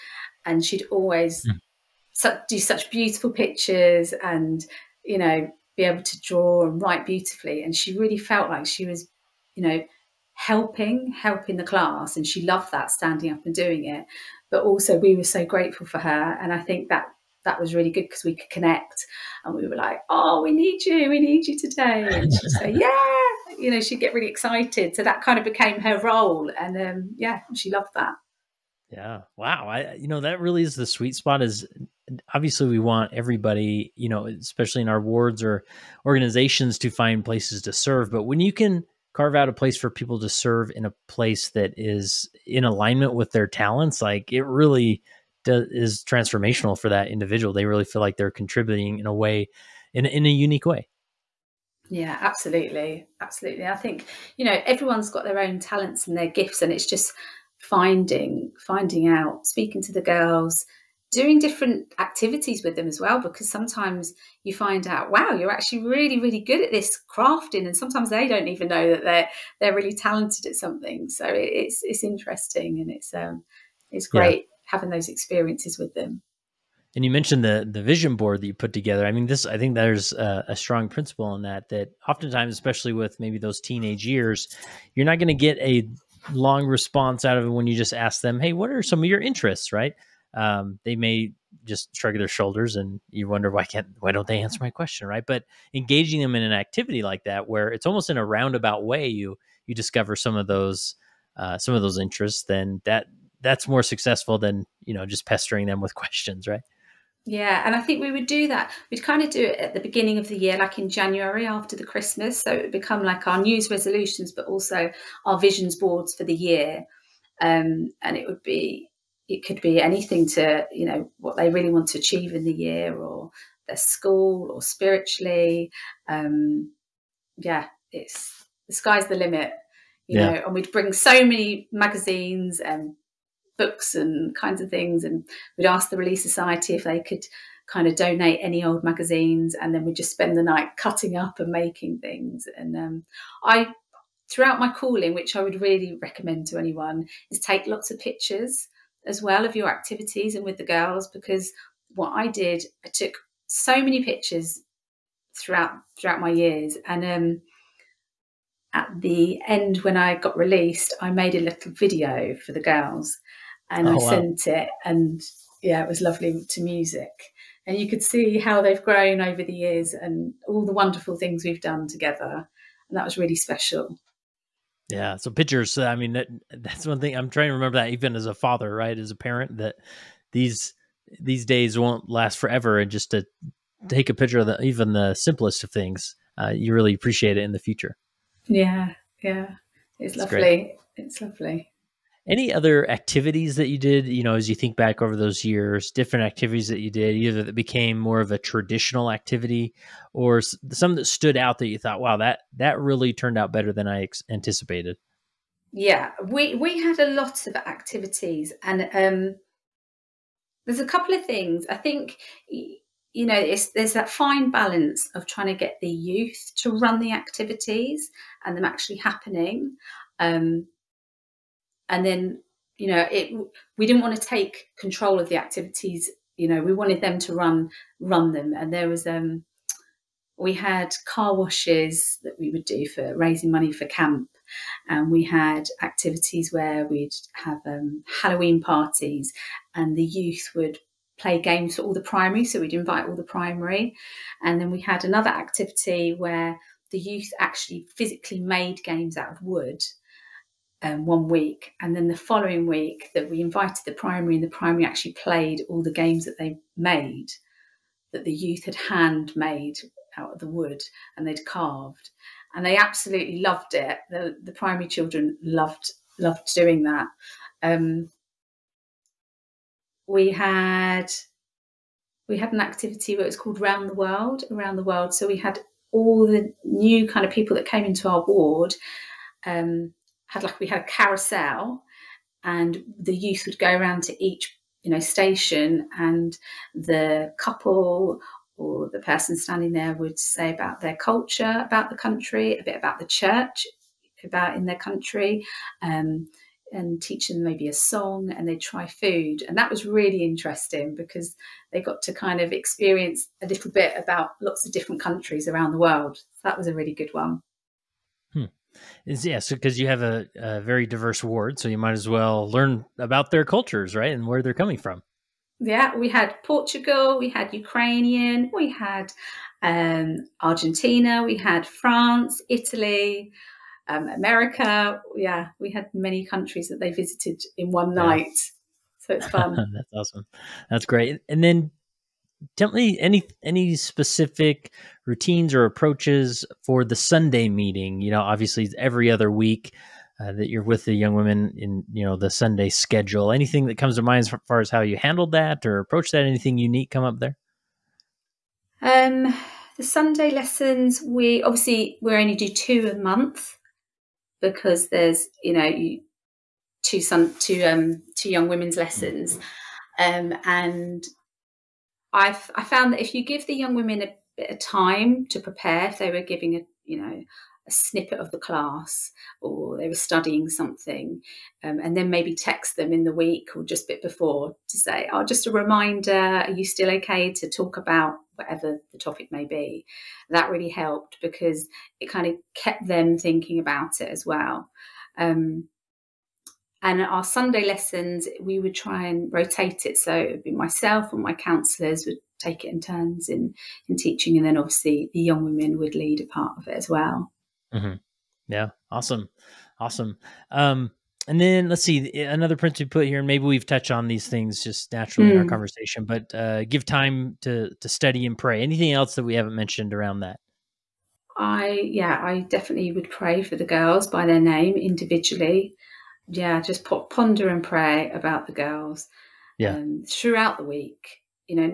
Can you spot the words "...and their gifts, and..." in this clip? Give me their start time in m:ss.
0:56.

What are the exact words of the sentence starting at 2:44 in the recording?
sent it and yeah, it was lovely to music.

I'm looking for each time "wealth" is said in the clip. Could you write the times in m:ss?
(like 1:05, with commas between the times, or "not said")
not said.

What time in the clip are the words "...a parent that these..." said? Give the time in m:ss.
2:59.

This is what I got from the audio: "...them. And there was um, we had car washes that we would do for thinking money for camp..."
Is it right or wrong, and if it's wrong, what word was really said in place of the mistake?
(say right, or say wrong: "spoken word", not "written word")
wrong: "raising", not "thinking".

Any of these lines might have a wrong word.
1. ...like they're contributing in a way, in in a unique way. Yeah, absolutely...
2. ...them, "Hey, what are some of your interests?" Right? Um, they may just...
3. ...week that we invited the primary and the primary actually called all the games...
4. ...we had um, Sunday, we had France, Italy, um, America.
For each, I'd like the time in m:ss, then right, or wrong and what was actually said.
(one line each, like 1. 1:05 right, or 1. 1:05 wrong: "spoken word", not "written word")
1. 0:48 right
2. 1:28 right
3. 4:12 wrong: "played", not "called"
4. 5:18 wrong: "Argentina", not "Sunday".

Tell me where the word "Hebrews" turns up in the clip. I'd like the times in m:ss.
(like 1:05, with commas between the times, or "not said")
not said.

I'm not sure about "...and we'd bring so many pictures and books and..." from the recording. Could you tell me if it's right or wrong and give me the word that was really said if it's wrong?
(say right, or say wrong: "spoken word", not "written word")
wrong: "magazines", not "pictures".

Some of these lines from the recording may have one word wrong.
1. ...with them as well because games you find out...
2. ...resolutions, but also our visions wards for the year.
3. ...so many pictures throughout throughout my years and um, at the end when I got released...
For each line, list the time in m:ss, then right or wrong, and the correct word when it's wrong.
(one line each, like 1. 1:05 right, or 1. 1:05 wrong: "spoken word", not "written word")
1. 1:02 wrong: "sometimes", not "games"
2. 1:53 wrong: "boards", not "wards"
3. 2:33 right.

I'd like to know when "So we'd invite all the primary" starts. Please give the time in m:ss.
4:02.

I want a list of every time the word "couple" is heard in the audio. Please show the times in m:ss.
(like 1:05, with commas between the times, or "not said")
3:30, 4:47.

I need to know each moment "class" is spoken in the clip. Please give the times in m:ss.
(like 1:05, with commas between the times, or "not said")
0:11, 6:08.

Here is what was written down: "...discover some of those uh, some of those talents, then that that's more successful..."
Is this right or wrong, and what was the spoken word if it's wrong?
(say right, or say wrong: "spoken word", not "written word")
wrong: "interests", not "talents".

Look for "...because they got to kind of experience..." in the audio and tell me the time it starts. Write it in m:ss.
5:00.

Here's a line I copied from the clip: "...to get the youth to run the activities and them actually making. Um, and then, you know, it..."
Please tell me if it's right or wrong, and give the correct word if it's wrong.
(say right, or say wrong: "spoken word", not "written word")
wrong: "happening", not "making".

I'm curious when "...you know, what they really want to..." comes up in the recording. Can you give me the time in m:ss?
2:00.